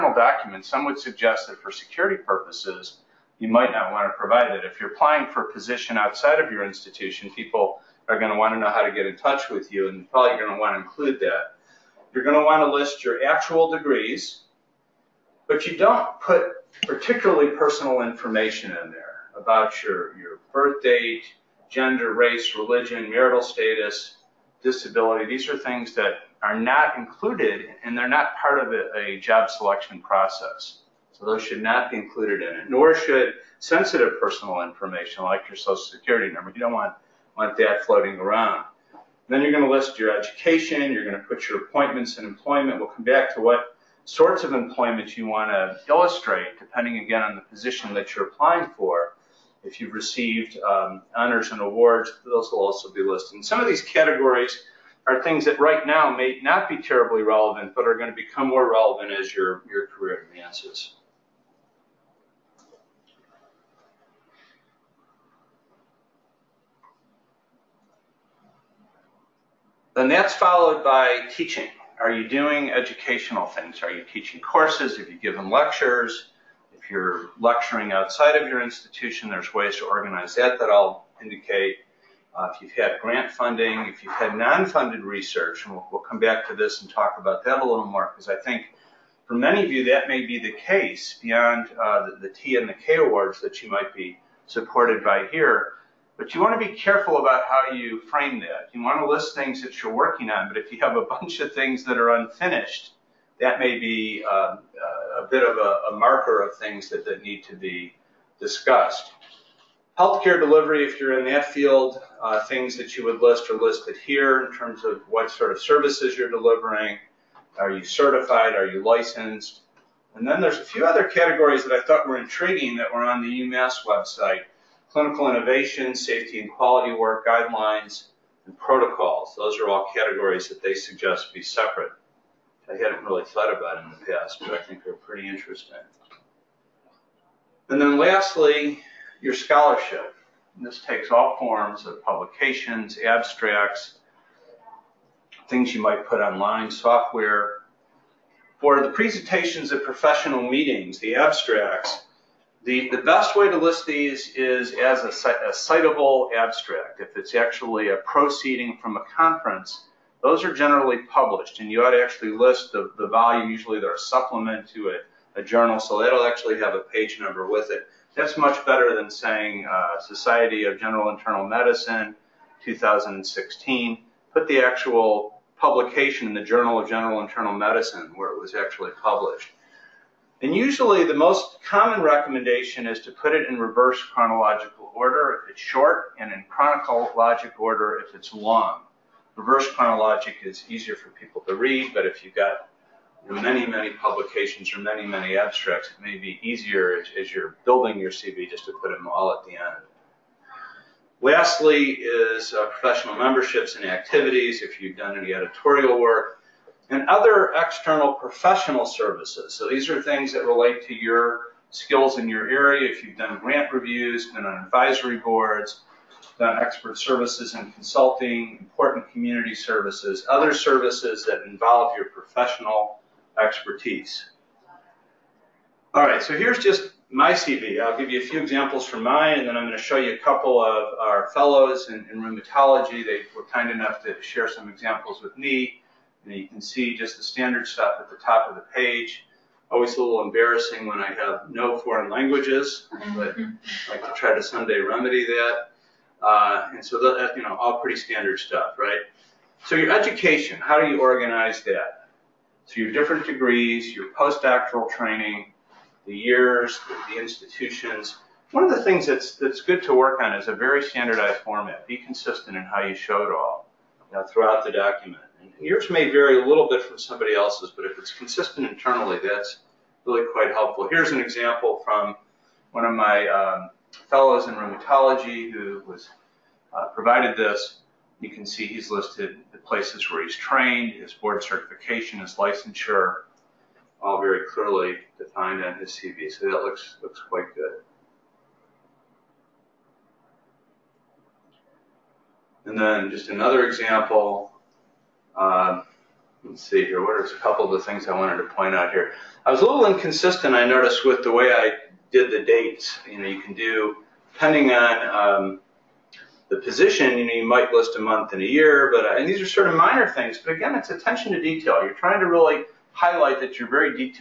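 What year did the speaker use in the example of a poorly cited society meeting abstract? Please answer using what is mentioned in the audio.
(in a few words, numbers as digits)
2016.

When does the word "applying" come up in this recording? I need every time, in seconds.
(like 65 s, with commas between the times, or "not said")
4 s, 48 s.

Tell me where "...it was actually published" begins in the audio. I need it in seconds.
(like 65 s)
178 s.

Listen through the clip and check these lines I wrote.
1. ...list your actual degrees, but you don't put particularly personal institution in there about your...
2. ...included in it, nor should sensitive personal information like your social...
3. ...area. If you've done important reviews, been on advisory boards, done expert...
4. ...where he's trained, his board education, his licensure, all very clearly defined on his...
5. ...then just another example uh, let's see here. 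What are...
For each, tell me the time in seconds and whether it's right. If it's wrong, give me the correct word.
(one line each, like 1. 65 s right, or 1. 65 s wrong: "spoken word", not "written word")
1. 12 s wrong: "information", not "institution"
2. 31 s right
3. 212 s wrong: "grant", not "important"
4. 280 s wrong: "certification", not "education"
5. 292 s right.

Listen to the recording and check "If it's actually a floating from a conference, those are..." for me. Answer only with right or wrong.
wrong.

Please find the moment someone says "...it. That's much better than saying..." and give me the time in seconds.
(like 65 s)
167 s.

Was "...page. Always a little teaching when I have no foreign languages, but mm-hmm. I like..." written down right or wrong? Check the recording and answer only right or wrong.
wrong.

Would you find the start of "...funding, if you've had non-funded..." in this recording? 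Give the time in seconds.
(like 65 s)
83 s.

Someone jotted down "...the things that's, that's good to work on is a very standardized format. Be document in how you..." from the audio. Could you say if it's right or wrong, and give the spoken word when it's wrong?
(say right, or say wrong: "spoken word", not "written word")
wrong: "consistent", not "document".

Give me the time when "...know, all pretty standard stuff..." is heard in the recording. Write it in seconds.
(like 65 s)
247 s.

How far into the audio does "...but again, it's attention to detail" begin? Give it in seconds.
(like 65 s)
310 s.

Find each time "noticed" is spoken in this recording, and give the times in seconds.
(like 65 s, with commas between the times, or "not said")
300 s.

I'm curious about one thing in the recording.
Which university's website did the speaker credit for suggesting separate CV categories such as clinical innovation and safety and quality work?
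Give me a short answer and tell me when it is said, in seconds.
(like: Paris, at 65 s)
UMass, at 123 s.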